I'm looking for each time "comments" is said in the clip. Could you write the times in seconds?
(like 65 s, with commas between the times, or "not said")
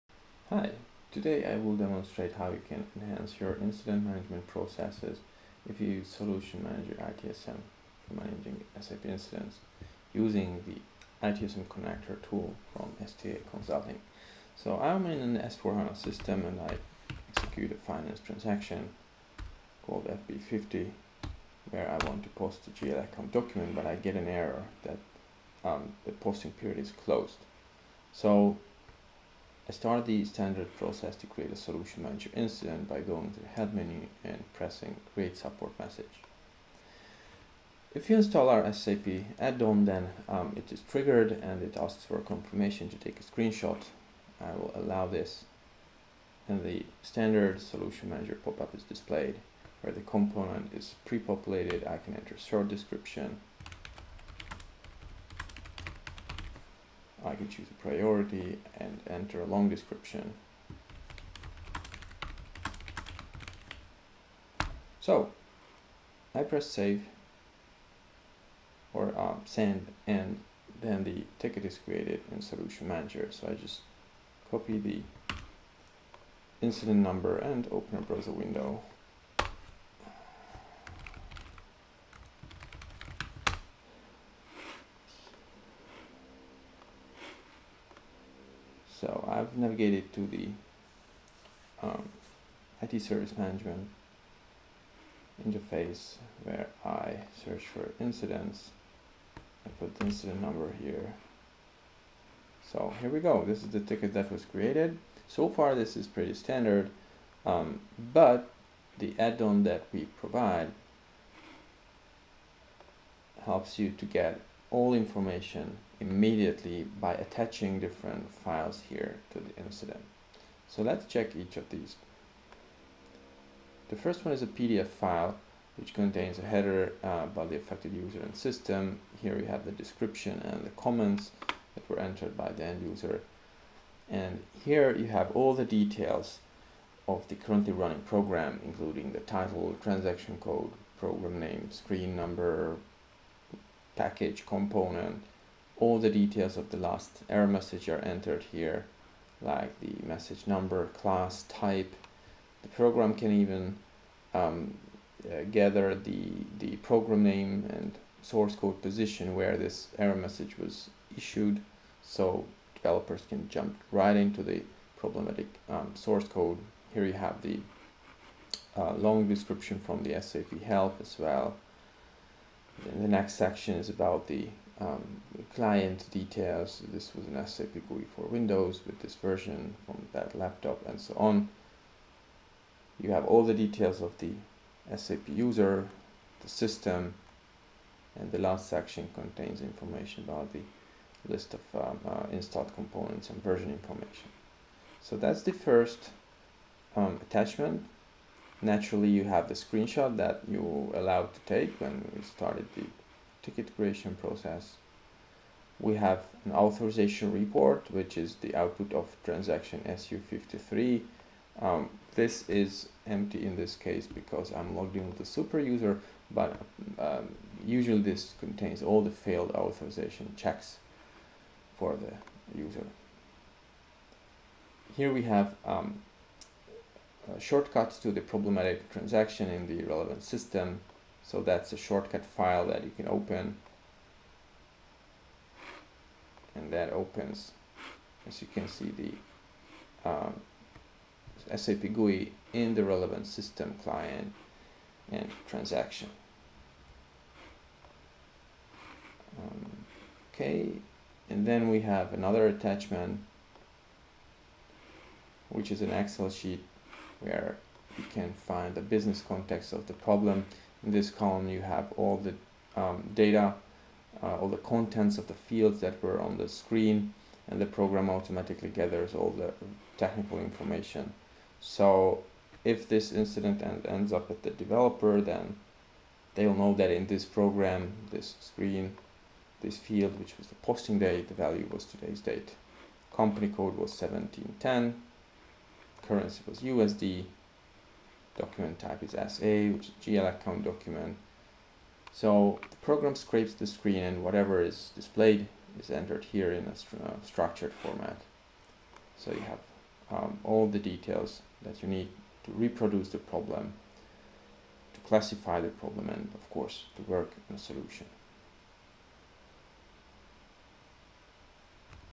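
130 s.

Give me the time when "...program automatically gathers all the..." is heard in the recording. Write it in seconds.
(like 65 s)
267 s.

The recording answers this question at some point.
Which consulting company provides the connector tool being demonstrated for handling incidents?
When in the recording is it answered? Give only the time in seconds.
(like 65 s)
13 s.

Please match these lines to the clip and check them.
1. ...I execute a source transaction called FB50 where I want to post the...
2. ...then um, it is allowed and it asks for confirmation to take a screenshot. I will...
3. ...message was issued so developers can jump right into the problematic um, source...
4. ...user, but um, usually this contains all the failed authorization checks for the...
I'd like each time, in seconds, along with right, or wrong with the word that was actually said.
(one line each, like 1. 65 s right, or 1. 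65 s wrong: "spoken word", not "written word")
1. 16 s wrong: "finance", not "source"
2. 39 s wrong: "triggered", not "allowed"
3. 160 s right
4. 215 s right.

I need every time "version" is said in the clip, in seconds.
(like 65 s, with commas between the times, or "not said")
179 s, 193 s.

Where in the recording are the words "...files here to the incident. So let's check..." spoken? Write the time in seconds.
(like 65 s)
118 s.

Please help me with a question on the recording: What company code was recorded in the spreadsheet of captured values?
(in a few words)
1710.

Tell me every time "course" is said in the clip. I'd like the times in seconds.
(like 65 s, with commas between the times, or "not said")
306 s.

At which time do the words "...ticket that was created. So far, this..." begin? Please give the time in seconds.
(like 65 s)
103 s.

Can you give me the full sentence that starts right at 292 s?
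So the program scrapes the screen and whatever is displayed is entered here in a st uh, structured format.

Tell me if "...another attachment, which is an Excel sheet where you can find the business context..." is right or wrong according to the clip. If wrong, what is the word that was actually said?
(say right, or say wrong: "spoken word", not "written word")
right.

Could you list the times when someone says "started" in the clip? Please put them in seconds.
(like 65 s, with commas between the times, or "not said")
29 s, 202 s.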